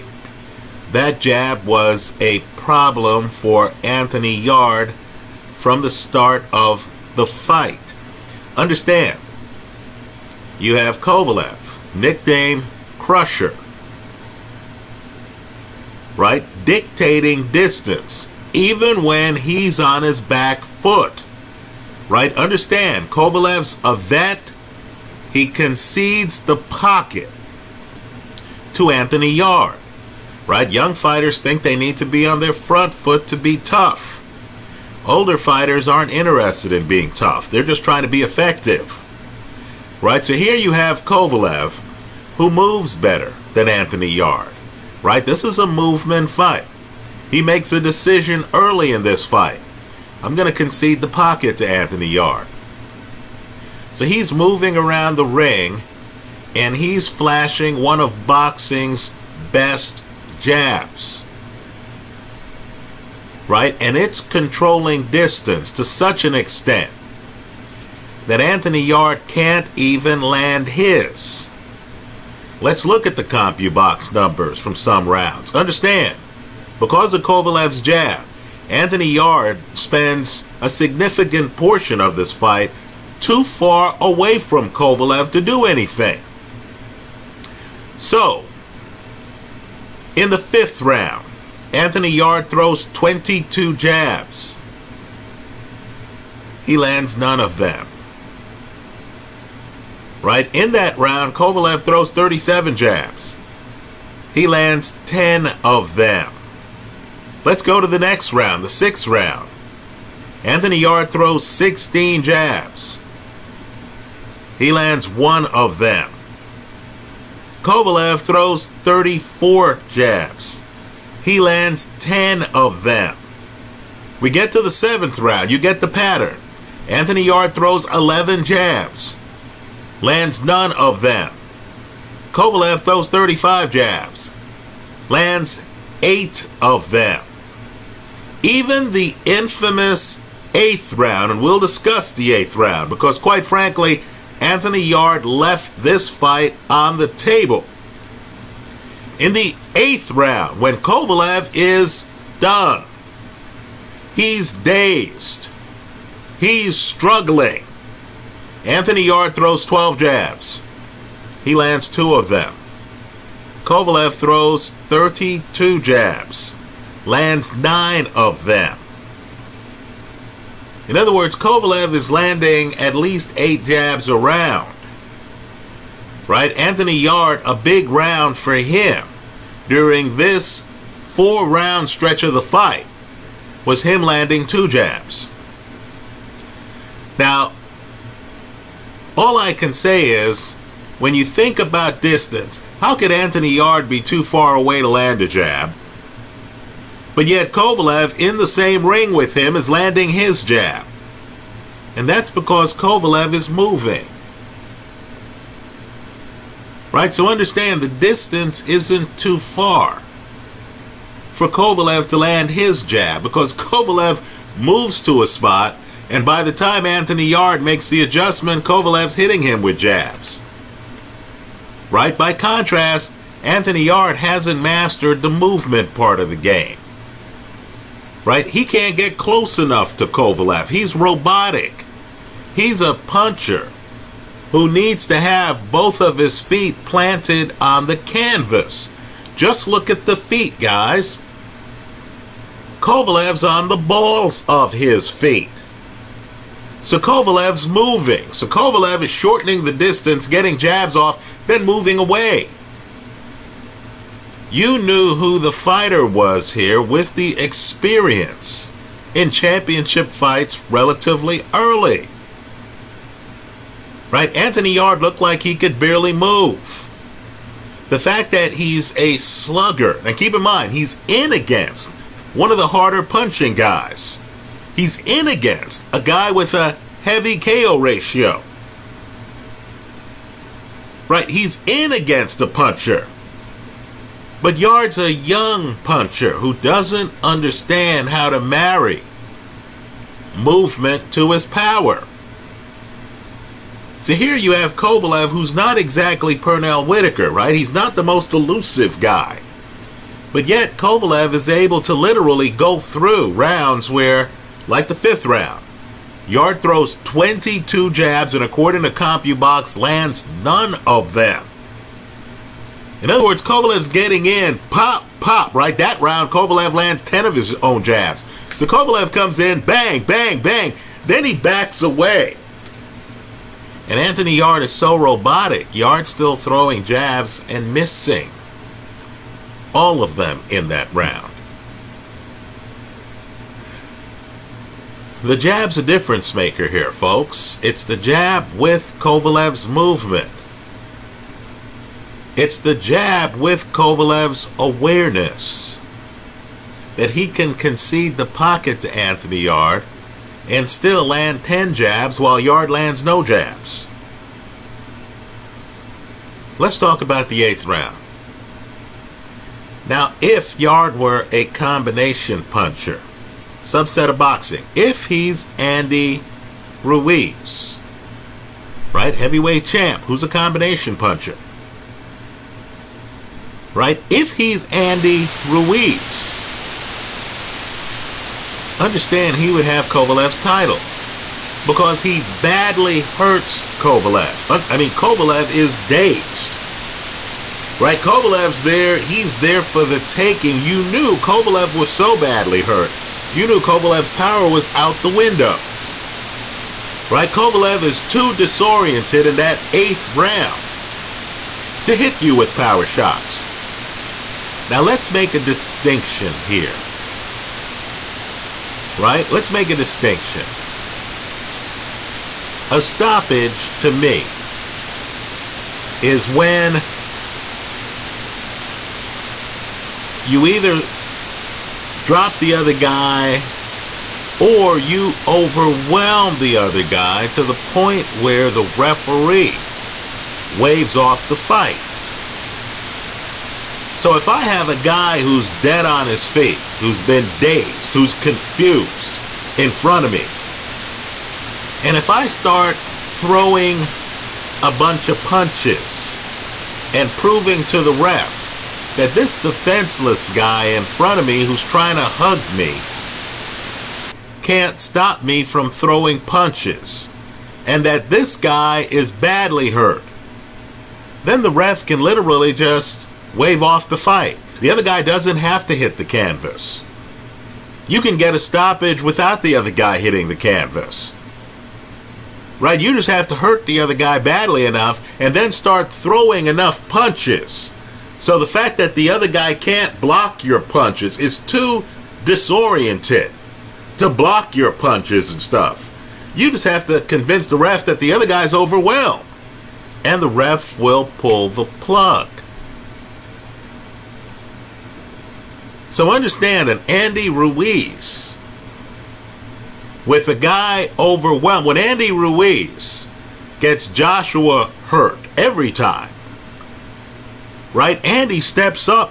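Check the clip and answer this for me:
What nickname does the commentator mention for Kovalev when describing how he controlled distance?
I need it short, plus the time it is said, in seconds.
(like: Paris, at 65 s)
Crusher, at 12 s.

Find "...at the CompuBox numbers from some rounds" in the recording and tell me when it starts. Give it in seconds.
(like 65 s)
73 s.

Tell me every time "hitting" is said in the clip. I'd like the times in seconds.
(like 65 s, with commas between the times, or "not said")
219 s, 469 s.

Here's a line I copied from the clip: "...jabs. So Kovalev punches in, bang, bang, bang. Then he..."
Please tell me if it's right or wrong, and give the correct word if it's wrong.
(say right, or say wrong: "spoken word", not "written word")
wrong: "comes", not "punches".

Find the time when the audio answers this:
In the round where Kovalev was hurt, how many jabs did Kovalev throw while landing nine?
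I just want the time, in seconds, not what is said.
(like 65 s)
164 s.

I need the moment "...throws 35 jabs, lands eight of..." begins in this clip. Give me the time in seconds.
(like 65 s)
132 s.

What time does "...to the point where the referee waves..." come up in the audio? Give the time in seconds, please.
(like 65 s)
427 s.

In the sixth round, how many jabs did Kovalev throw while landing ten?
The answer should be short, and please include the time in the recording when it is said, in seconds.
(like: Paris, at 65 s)
34, at 118 s.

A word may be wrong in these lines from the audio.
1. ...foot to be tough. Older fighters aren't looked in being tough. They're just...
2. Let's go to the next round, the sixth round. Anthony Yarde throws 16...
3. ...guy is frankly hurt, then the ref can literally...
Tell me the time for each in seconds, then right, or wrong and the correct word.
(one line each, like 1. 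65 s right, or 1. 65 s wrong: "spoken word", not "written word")
1. 32 s wrong: "interested", not "looked"
2. 107 s right
3. 458 s wrong: "badly", not "frankly".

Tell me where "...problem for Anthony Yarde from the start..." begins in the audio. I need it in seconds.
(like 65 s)
2 s.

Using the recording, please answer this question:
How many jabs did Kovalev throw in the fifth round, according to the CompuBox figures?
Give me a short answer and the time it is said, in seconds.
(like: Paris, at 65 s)
37, at 102 s.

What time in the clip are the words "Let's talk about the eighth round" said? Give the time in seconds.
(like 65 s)
356 s.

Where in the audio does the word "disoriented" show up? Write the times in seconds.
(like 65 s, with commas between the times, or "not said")
398 s, 482 s.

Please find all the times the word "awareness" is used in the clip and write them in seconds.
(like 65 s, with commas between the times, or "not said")
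344 s.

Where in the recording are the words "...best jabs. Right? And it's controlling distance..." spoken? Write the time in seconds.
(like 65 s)
59 s.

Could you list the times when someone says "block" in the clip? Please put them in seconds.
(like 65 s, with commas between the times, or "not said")
480 s, 484 s.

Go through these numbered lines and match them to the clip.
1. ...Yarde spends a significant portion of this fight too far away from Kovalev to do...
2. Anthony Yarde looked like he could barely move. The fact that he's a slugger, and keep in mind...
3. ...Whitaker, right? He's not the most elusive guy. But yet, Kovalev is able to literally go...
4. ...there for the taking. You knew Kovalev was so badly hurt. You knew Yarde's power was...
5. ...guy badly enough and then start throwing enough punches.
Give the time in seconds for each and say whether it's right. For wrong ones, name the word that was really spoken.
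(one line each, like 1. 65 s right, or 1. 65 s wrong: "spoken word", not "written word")
1. 79 s right
2. 264 s right
3. 296 s right
4. 389 s wrong: "Kovalev", not "Yarde"
5. 473 s right.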